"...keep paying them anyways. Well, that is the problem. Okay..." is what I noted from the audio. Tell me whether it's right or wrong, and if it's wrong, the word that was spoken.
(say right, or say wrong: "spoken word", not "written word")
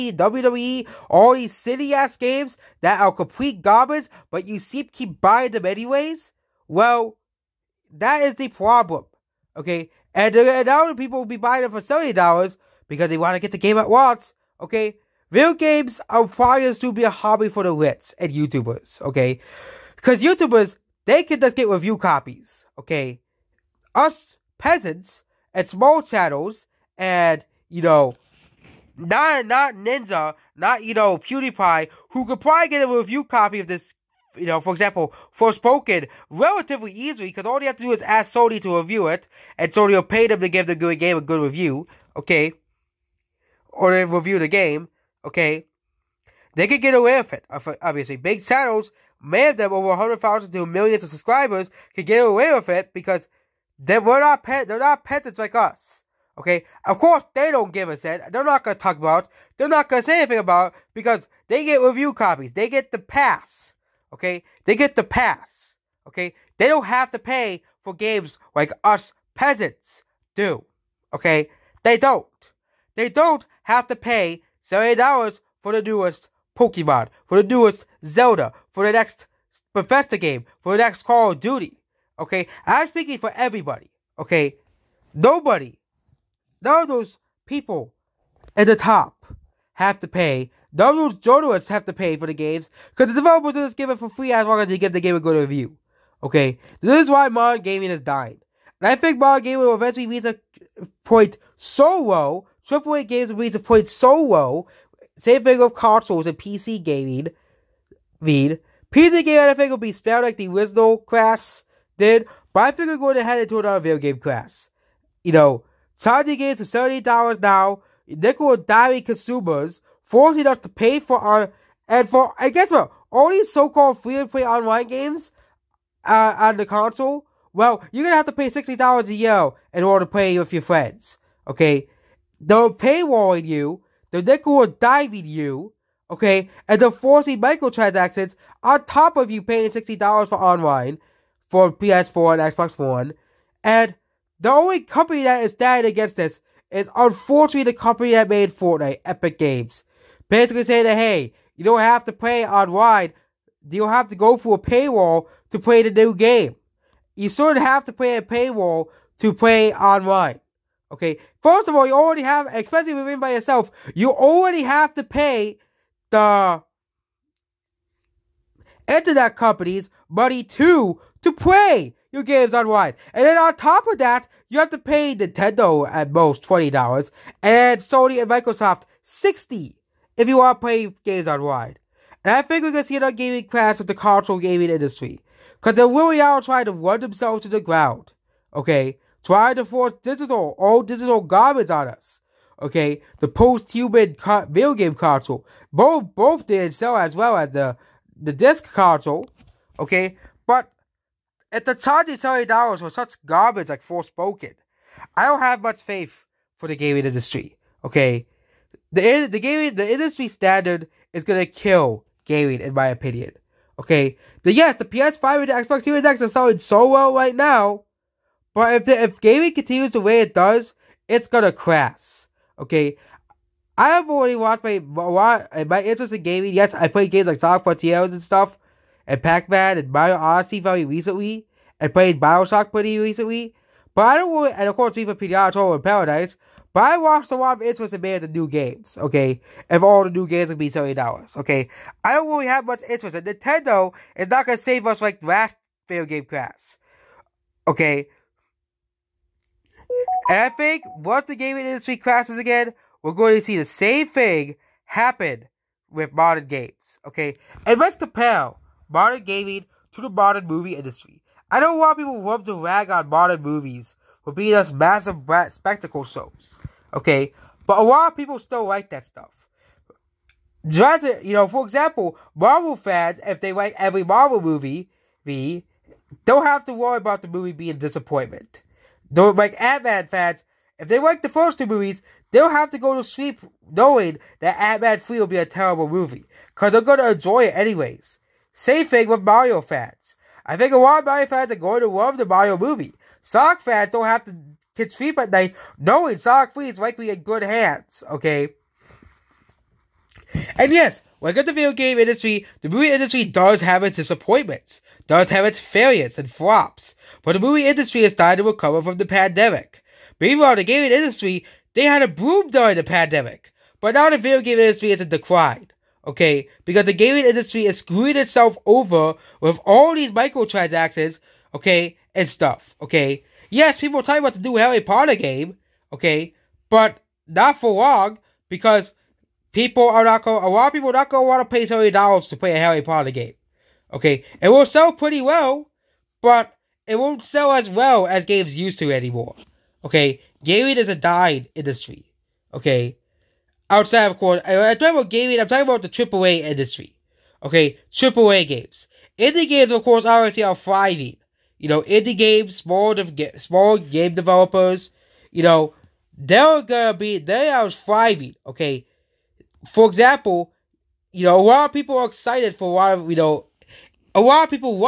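wrong: "buying", not "paying".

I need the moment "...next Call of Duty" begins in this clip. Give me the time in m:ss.
1:20.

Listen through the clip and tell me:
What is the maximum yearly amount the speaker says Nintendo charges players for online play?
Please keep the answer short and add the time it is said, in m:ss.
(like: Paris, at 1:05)
$20, at 2:56.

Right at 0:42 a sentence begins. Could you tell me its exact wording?
Okay, or they review the game.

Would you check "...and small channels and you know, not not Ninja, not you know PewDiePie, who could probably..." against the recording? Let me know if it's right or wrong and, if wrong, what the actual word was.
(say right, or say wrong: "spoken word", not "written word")
right.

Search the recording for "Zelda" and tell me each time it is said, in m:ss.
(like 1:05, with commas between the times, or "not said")
1:18.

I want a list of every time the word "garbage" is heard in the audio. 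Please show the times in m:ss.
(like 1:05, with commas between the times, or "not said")
0:03, 3:11, 3:23.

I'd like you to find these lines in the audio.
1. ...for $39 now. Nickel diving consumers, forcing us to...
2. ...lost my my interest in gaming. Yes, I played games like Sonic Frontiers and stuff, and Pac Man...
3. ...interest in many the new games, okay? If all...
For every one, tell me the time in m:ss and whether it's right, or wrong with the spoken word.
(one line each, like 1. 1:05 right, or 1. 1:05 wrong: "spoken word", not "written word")
1. 1:56 wrong: "30", not "39"
2. 3:44 right
3. 3:57 right.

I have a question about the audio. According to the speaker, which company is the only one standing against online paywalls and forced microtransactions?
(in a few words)
Epic Games.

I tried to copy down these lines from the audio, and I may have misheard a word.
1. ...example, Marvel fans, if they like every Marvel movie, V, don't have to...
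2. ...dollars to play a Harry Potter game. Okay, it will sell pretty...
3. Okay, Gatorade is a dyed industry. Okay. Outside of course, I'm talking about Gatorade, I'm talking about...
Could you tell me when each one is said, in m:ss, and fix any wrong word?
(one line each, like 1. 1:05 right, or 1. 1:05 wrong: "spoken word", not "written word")
1. 4:31 right
2. 5:31 right
3. 5:39 right.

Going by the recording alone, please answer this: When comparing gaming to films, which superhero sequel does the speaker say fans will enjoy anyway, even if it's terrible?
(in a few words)
Ant Man 3.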